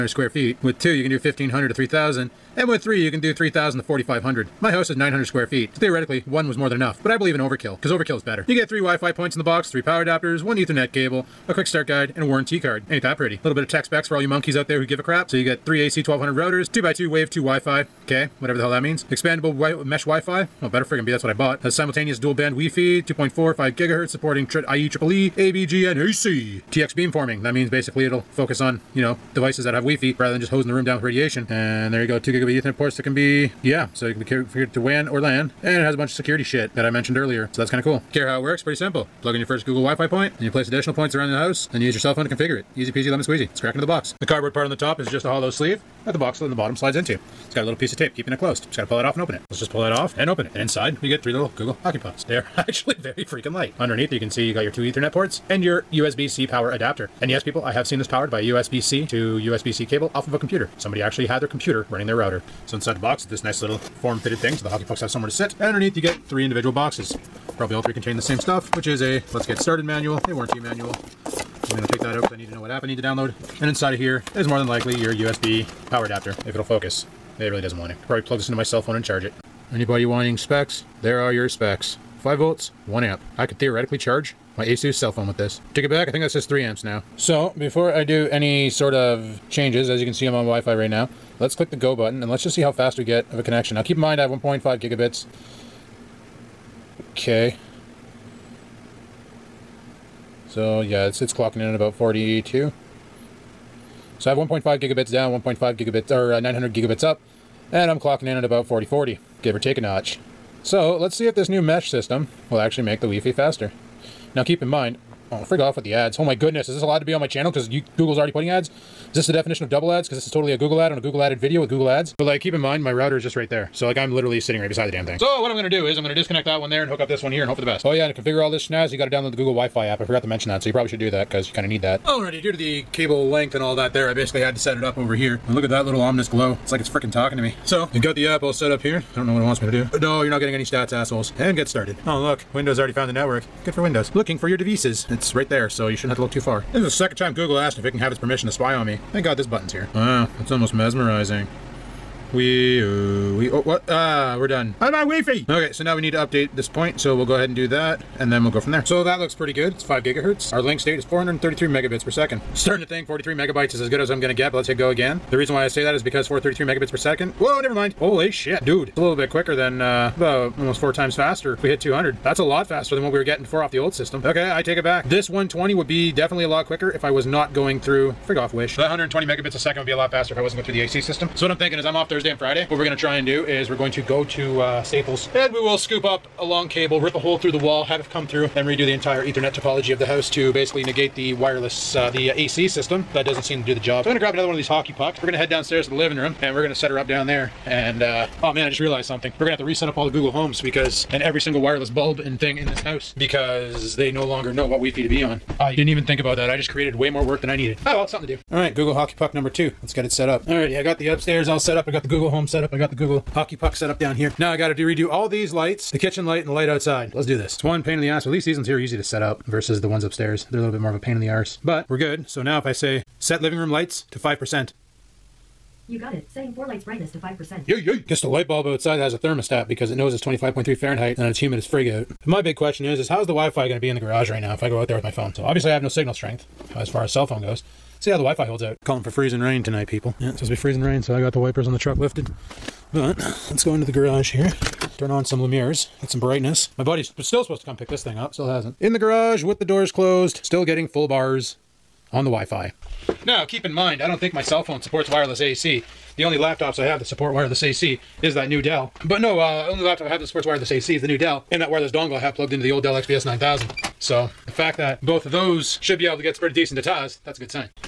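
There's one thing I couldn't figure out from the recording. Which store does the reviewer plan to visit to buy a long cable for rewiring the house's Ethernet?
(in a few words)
Staples.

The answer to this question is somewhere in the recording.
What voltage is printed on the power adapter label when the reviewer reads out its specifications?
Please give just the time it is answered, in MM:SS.
01:22.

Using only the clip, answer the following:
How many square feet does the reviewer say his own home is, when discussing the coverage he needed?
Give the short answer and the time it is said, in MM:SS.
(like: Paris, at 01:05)
900, at 00:04.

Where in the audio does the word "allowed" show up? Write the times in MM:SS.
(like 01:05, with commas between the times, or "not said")
01:56.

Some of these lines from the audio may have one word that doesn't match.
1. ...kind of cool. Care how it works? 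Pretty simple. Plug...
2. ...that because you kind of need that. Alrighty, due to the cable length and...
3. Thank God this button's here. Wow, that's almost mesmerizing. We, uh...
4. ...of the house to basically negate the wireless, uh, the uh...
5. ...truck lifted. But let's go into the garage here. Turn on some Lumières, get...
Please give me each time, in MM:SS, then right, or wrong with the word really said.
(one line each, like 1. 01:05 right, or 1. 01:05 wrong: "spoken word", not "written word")
1. 00:37 right
2. 02:11 right
3. 02:29 right
4. 03:09 right
5. 04:01 right.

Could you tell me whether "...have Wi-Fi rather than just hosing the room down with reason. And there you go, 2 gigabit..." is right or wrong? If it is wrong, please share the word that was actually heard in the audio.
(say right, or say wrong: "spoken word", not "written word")
wrong: "radiation", not "reason".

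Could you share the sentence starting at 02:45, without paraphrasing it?
The reason why I say that is because 433 megabits per second.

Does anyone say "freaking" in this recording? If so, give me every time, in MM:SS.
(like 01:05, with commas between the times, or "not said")
00:53, 02:16.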